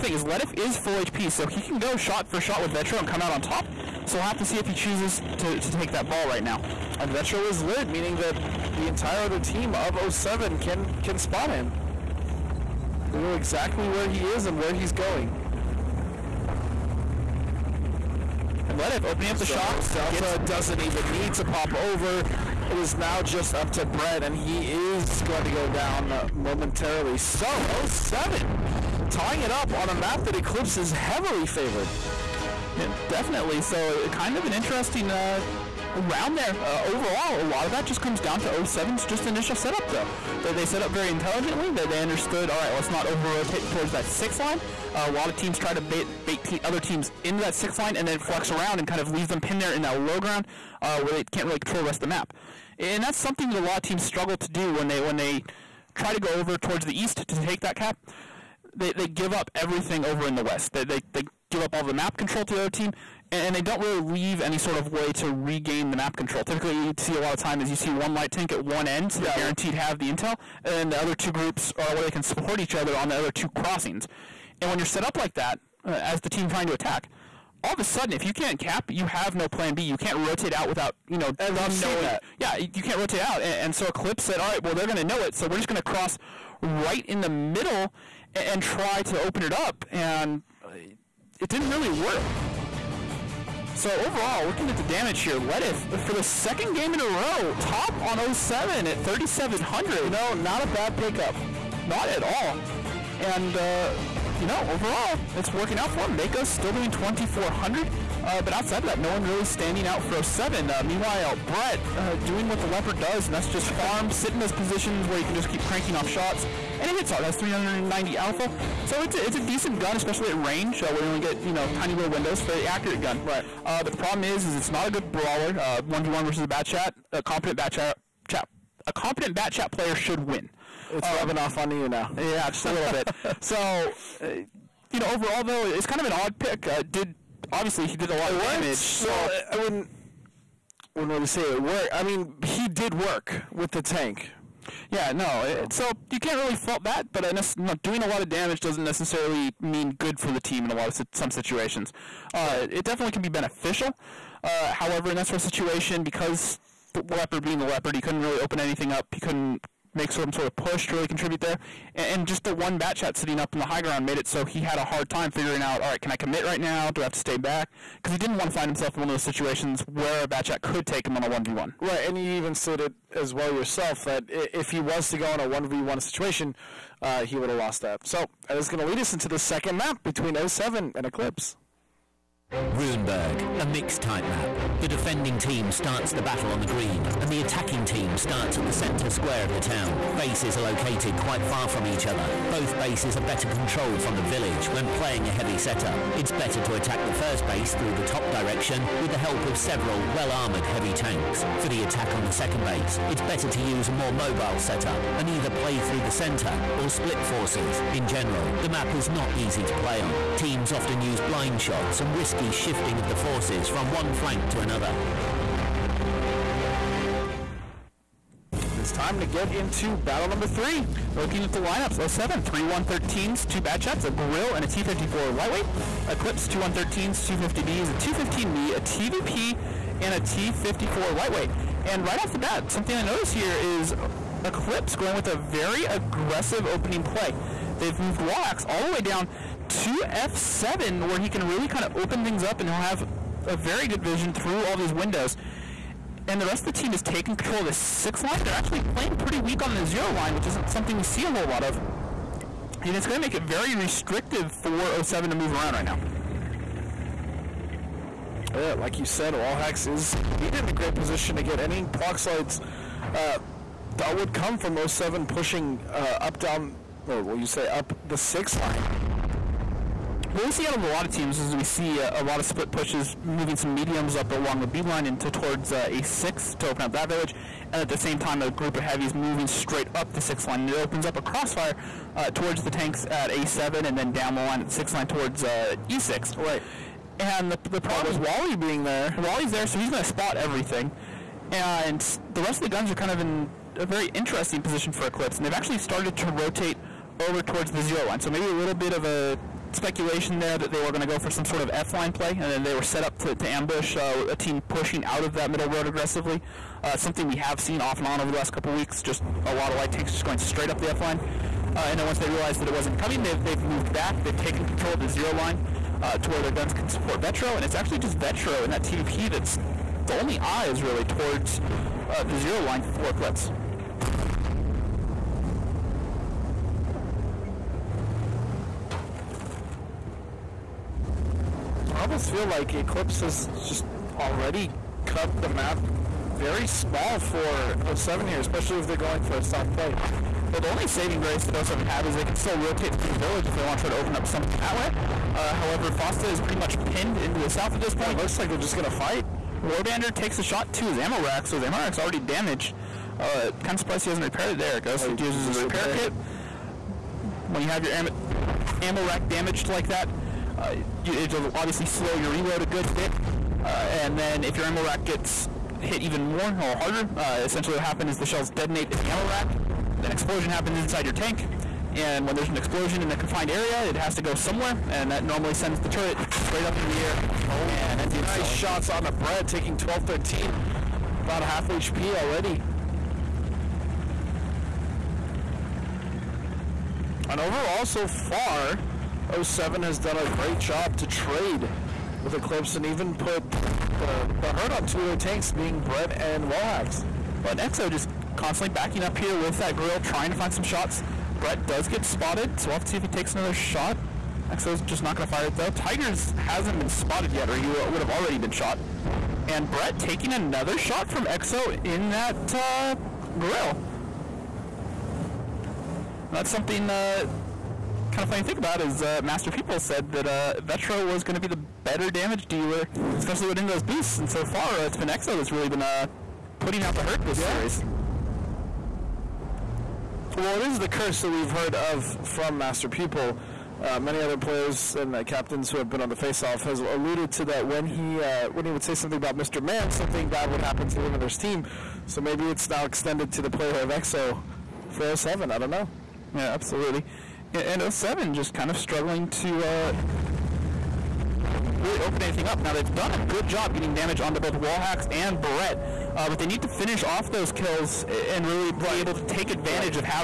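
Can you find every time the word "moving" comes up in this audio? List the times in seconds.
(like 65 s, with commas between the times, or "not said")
273 s, 279 s.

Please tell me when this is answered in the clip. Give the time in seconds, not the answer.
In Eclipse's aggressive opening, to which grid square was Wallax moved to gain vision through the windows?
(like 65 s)
240 s.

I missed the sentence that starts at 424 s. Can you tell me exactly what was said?
And so far, it's been Exo that's really been uh, putting out the hurt this yeah.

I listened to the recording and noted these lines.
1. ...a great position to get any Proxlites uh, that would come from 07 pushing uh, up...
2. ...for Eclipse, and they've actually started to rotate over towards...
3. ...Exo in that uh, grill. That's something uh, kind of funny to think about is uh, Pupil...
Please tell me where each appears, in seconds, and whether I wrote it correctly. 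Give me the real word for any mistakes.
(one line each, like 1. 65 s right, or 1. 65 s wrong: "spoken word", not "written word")
1. 260 s right
2. 294 s right
3. 411 s wrong: "Master", not "Pupil".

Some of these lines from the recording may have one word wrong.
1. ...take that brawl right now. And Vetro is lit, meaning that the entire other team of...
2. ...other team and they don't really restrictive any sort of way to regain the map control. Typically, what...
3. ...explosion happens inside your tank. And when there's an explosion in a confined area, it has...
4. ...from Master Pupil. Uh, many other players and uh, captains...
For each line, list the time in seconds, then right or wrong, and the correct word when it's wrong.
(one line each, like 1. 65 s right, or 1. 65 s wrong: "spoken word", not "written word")
1. 5 s right
2. 62 s wrong: "leave", not "restrictive"
3. 370 s right
4. 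432 s right.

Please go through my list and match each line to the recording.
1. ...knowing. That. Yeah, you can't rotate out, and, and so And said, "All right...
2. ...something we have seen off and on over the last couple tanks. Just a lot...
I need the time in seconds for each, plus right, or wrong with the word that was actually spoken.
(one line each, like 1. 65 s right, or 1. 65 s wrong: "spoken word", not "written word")
1. 81 s wrong: "Eclipse", not "And"
2. 306 s wrong: "weeks", not "tanks".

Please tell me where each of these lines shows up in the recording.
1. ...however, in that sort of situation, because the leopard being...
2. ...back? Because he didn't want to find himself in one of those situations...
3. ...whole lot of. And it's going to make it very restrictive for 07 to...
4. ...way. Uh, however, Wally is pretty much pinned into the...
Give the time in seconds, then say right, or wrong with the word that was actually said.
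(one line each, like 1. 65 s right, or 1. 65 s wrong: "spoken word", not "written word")
1. 154 s right
2. 167 s right
3. 251 s right
4. 344 s wrong: "Fosta", not "Wally".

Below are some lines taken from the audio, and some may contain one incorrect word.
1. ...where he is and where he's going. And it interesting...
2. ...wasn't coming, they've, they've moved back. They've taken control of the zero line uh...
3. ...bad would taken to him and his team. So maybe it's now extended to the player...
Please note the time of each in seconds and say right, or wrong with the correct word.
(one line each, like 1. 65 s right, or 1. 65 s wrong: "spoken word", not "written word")
1. 13 s wrong: "opening", not "interesting"
2. 312 s right
3. 440 s wrong: "happen", not "taken".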